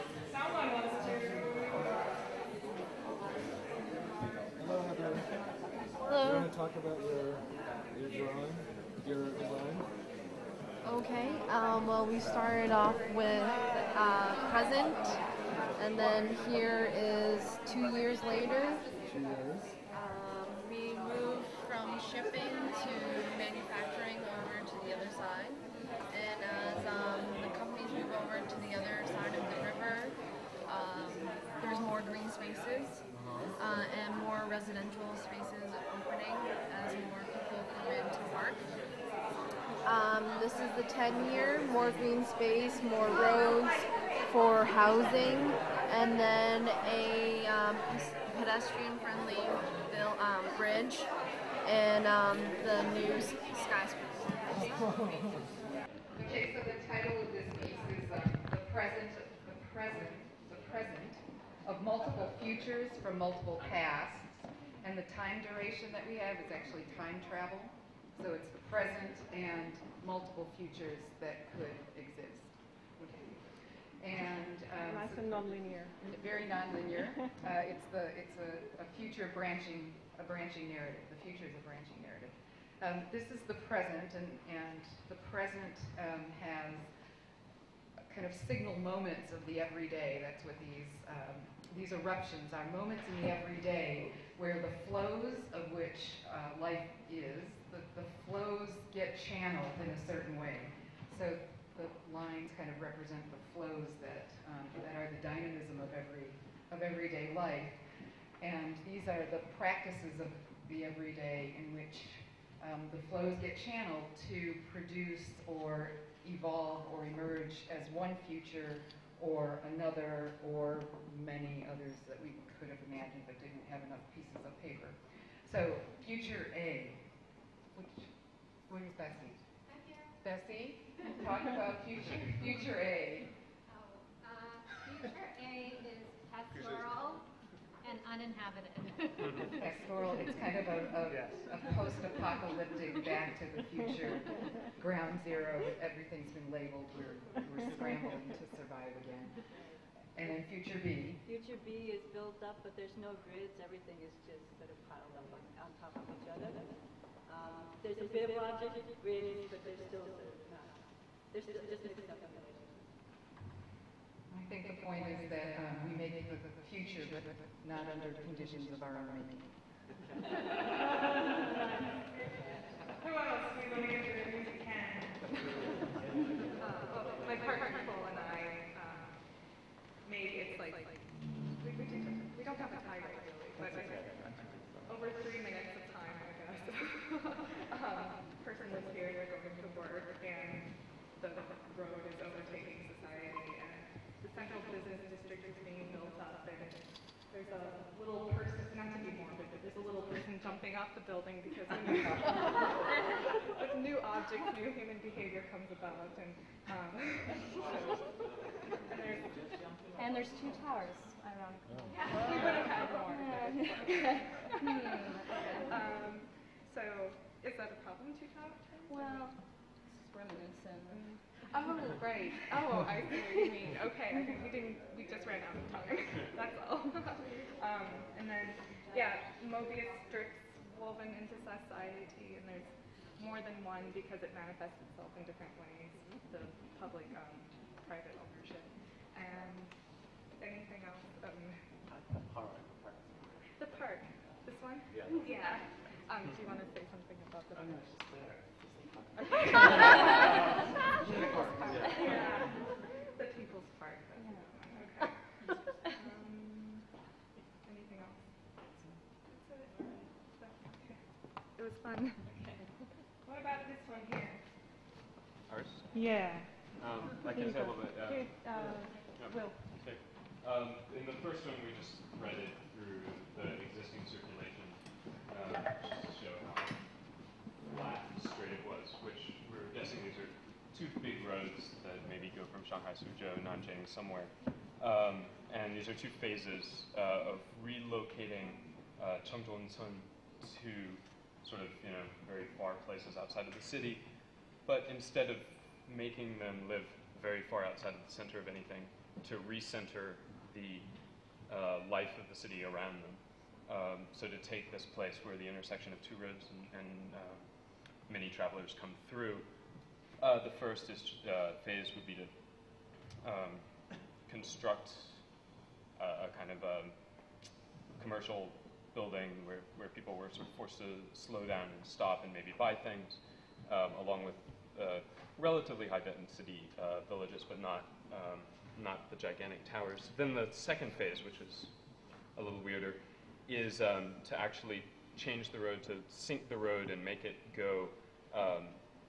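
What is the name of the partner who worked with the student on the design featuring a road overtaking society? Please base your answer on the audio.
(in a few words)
Cole.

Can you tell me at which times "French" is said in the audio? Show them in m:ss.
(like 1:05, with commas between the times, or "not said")
not said.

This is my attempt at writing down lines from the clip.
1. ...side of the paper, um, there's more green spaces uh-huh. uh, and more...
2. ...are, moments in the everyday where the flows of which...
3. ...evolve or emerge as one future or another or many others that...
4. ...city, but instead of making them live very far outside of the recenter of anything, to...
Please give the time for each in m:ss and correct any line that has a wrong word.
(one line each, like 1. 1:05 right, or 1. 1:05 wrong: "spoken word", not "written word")
1. 0:29 wrong: "river", not "paper"
2. 1:32 right
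3. 1:56 right
4. 4:53 wrong: "center", not "recenter".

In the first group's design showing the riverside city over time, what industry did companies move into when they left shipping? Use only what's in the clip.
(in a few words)
manufacturing.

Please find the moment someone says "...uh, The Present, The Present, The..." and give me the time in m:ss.
0:58.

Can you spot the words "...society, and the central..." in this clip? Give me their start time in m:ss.
3:12.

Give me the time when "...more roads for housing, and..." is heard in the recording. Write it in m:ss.
0:42.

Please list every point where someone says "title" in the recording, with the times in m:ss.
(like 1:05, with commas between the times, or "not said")
0:56, 3:02.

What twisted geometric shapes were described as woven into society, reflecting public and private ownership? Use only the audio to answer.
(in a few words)
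Mobius strips.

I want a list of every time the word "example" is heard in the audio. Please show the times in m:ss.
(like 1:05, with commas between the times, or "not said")
not said.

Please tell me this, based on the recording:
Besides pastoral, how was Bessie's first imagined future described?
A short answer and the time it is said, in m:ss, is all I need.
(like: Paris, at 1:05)
uninhabited, at 2:18.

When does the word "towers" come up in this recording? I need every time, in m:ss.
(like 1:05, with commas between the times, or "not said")
3:30, 3:38, 5:29.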